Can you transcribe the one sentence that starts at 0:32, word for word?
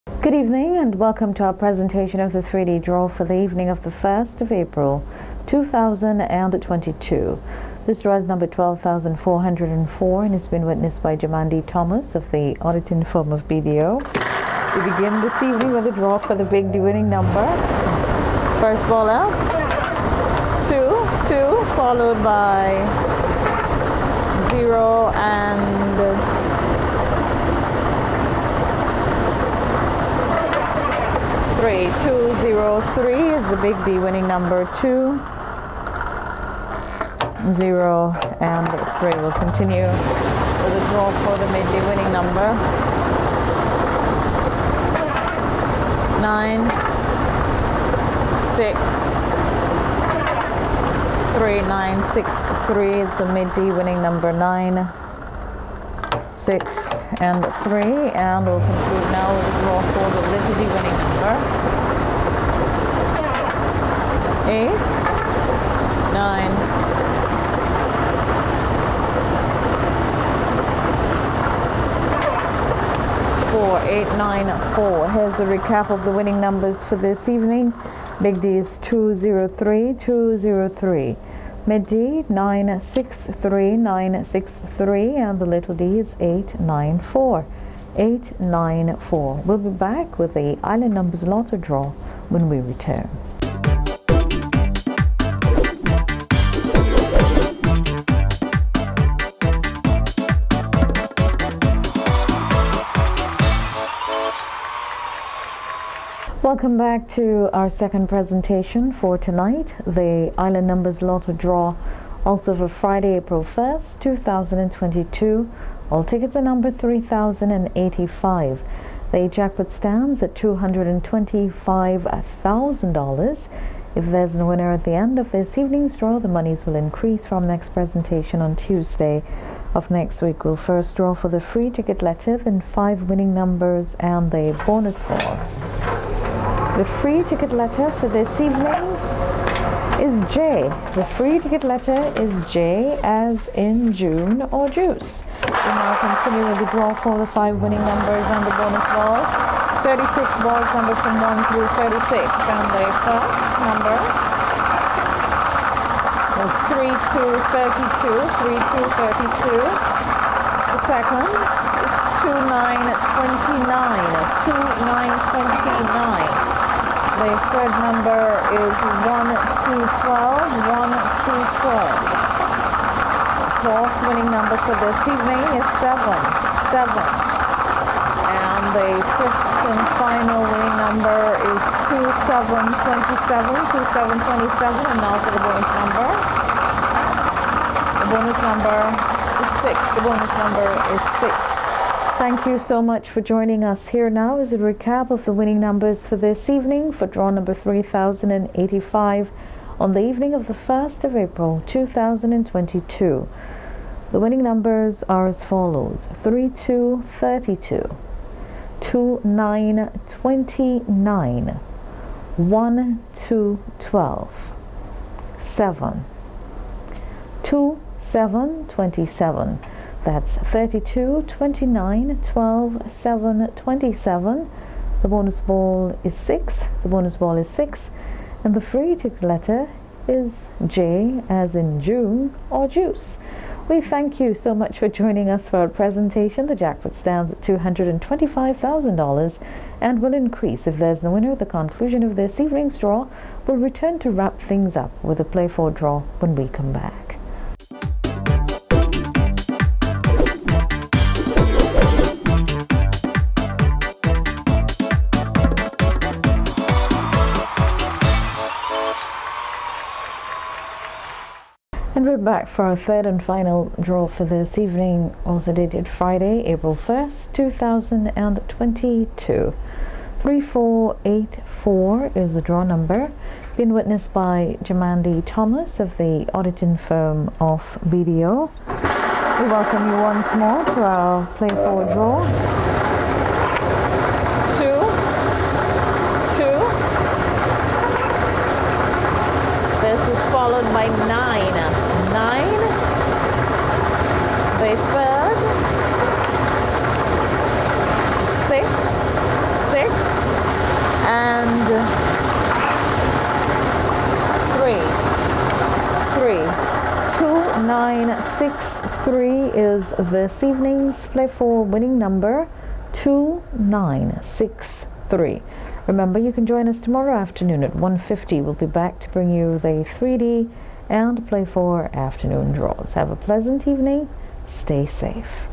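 Two zero three is the big D winning number two.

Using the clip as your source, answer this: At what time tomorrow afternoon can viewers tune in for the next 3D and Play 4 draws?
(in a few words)
1.50.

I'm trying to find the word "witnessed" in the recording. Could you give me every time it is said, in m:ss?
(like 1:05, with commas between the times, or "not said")
0:10, 4:33.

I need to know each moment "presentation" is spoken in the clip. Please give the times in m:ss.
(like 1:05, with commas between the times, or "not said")
0:01, 1:48, 2:07, 3:55.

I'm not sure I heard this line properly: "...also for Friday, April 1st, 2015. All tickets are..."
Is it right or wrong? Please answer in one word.
wrong.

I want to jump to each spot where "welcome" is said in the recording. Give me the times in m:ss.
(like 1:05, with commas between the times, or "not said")
0:00, 1:46, 4:39.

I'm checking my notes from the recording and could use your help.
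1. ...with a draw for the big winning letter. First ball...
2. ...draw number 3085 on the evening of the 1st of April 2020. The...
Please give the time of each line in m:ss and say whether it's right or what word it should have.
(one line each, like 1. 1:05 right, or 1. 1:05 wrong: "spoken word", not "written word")
1. 0:15 wrong: "number", not "letter"
2. 3:17 wrong: "2022", not "2020".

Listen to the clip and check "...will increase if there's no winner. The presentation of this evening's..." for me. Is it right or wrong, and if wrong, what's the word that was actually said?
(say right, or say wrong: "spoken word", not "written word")
wrong: "conclusion", not "presentation".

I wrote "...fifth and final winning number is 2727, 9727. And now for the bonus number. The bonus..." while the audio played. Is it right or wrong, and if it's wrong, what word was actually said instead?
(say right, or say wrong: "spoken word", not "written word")
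wrong: "2727", not "9727".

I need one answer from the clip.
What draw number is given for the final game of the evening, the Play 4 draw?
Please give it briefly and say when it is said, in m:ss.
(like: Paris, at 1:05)
3484, at 4:30.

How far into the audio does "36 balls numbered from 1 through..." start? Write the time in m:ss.
2:29.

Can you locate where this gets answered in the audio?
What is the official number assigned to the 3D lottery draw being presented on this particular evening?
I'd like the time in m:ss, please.
0:08.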